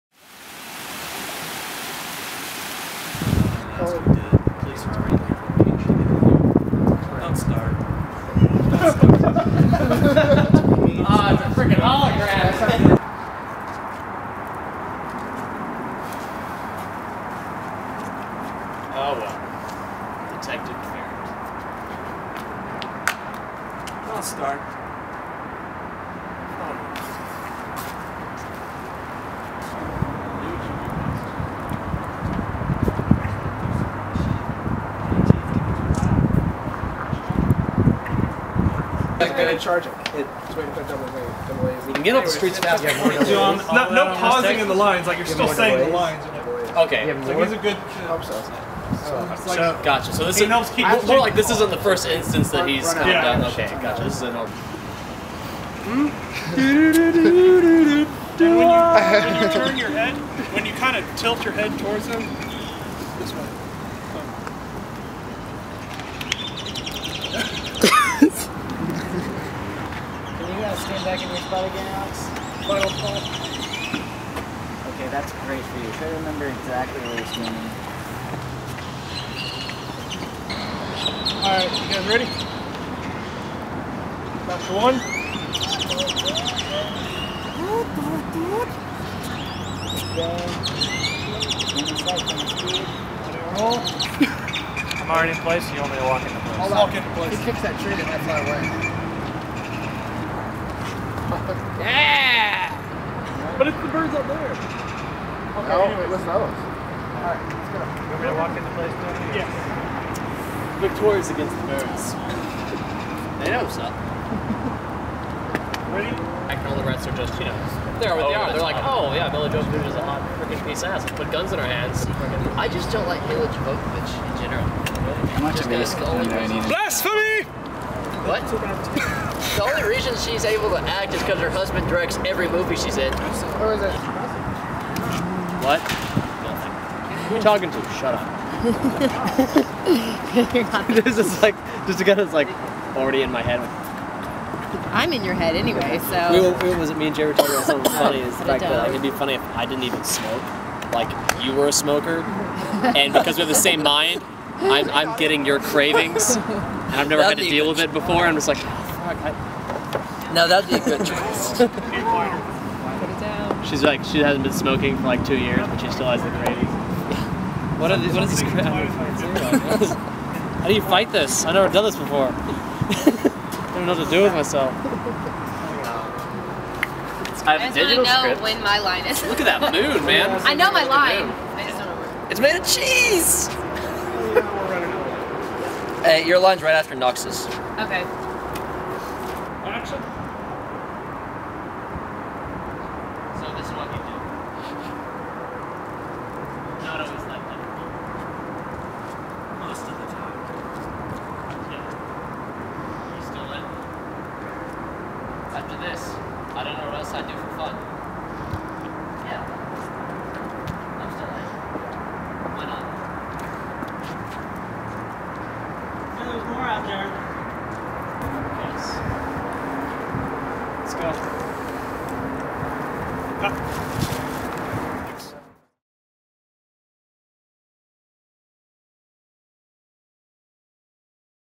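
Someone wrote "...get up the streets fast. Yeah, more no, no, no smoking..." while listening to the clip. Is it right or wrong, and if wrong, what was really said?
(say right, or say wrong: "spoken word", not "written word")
wrong: "pausing", not "smoking".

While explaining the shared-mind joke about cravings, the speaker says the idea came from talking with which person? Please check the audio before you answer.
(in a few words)
Jerry.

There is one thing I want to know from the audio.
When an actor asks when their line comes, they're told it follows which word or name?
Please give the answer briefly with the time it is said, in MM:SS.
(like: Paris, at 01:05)
Noxus, at 03:06.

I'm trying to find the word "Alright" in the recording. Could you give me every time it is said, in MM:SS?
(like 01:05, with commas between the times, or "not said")
01:21, 01:46.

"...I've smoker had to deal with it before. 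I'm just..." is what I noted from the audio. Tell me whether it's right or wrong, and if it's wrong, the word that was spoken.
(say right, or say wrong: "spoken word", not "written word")
wrong: "never", not "smoker".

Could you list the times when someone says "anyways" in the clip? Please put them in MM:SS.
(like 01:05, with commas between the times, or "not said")
01:45, 02:25.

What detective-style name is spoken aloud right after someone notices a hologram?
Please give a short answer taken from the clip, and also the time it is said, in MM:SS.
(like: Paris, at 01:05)
Detective Ferret, at 00:20.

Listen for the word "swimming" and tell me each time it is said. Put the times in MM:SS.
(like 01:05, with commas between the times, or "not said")
01:17.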